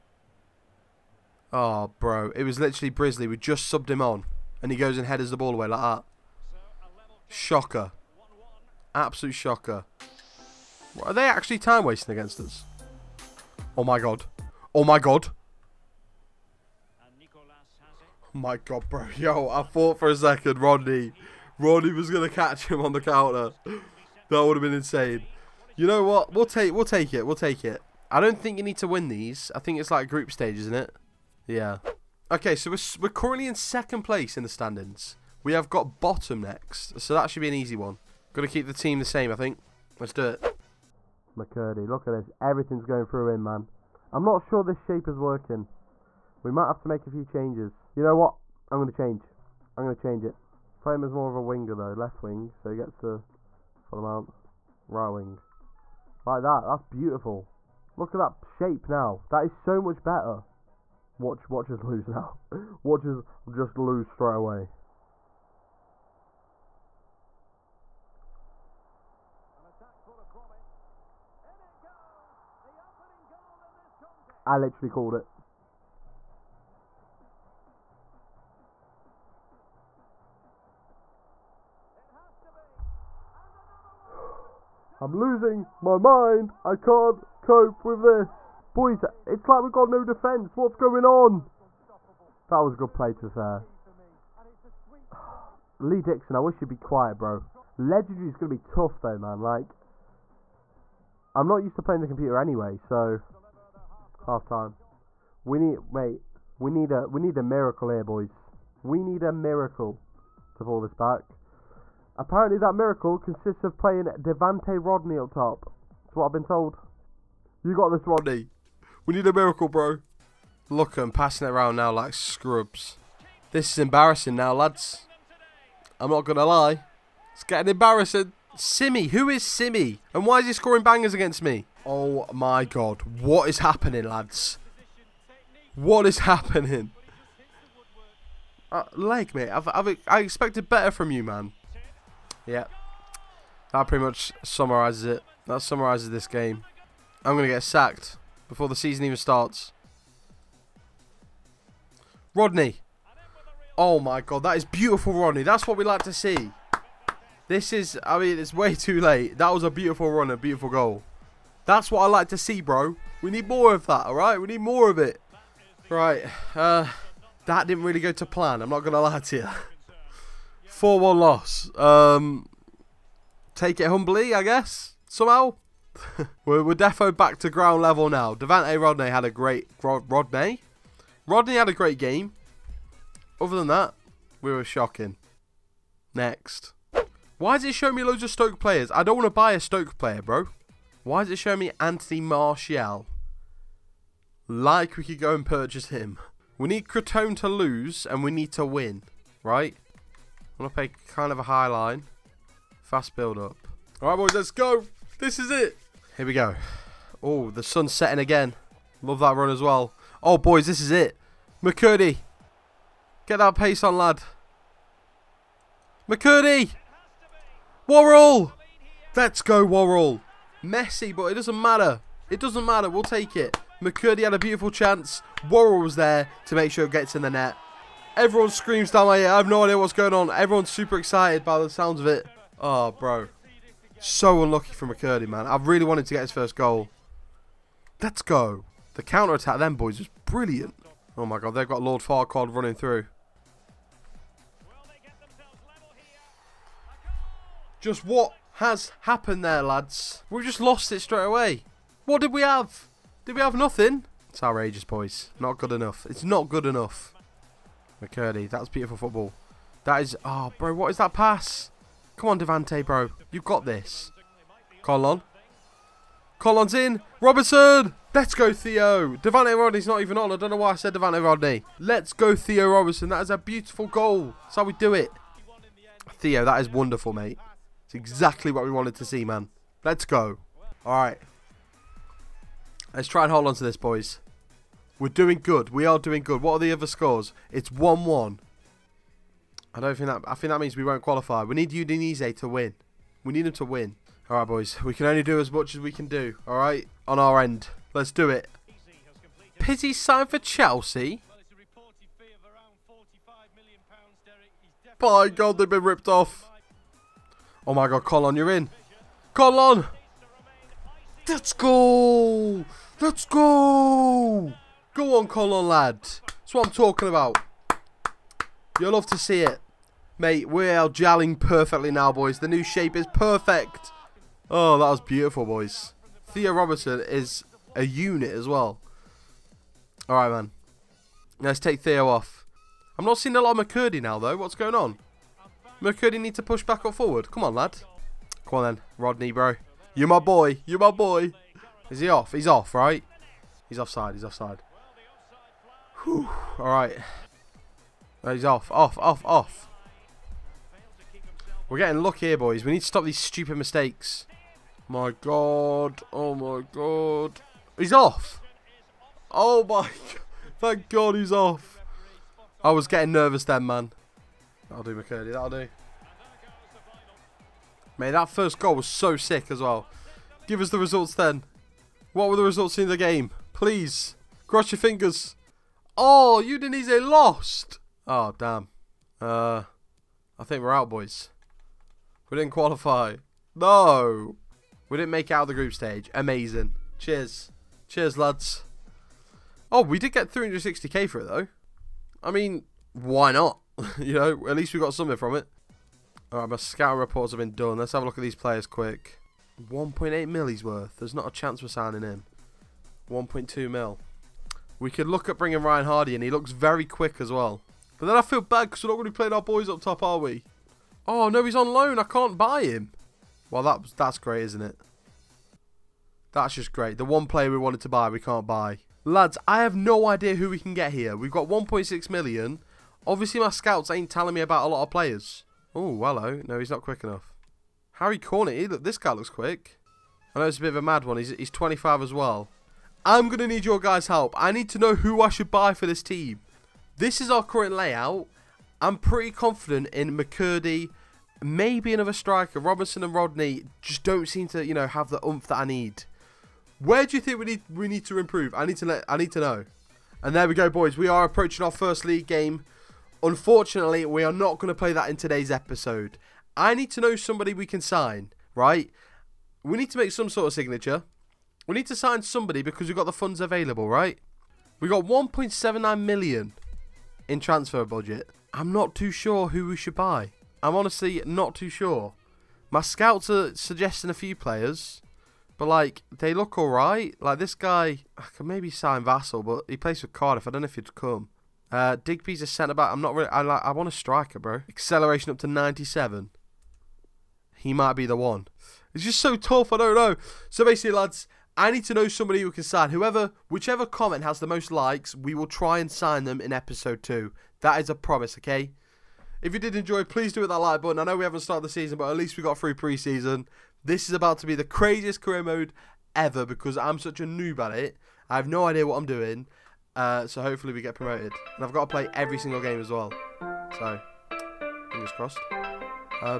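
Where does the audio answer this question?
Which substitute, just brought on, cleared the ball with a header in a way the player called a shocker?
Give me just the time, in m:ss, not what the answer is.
0:02.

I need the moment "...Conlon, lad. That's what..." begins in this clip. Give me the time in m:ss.
5:15.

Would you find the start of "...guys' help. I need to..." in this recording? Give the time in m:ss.
7:13.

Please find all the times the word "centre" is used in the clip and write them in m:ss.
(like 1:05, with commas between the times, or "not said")
8:02.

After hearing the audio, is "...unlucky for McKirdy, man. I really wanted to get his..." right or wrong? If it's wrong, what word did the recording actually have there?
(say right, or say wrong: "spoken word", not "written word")
right.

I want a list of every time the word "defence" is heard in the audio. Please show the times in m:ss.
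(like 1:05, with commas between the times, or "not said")
1:30.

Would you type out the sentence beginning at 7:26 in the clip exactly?
Where do you think we need we need to improve?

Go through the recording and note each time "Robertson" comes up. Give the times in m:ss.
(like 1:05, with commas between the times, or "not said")
4:27, 4:32, 5:26.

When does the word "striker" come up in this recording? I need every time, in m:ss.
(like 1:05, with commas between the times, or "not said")
7:22, 8:03.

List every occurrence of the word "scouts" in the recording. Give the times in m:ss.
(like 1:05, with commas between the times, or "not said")
6:36, 7:03, 7:52.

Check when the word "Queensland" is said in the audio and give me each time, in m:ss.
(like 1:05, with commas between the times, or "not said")
not said.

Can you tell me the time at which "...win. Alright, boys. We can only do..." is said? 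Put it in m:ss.
4:53.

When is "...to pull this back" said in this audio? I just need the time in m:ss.
1:50.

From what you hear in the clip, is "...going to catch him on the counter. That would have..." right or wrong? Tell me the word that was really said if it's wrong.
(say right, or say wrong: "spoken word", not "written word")
right.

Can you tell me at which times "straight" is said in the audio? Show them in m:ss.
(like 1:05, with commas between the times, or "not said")
1:04, 4:11.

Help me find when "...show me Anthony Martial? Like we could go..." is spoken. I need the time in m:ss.
3:11.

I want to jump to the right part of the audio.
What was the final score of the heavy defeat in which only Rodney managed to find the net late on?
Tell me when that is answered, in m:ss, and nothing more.
2:50.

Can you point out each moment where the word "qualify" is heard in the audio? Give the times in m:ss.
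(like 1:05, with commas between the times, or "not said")
4:51, 6:22.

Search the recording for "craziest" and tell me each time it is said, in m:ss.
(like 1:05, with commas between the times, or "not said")
8:24.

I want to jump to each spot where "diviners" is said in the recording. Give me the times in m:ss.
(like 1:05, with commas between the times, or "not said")
not said.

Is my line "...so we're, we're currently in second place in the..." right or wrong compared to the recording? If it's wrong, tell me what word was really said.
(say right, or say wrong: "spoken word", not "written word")
right.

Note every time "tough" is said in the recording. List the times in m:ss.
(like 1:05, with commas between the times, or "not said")
1:38, 8:09.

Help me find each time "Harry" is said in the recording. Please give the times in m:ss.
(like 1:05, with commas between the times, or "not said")
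7:07.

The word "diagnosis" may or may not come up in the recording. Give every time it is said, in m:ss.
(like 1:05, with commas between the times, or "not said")
not said.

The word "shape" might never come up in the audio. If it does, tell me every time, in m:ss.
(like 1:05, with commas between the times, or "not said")
0:44, 0:58, 5:22.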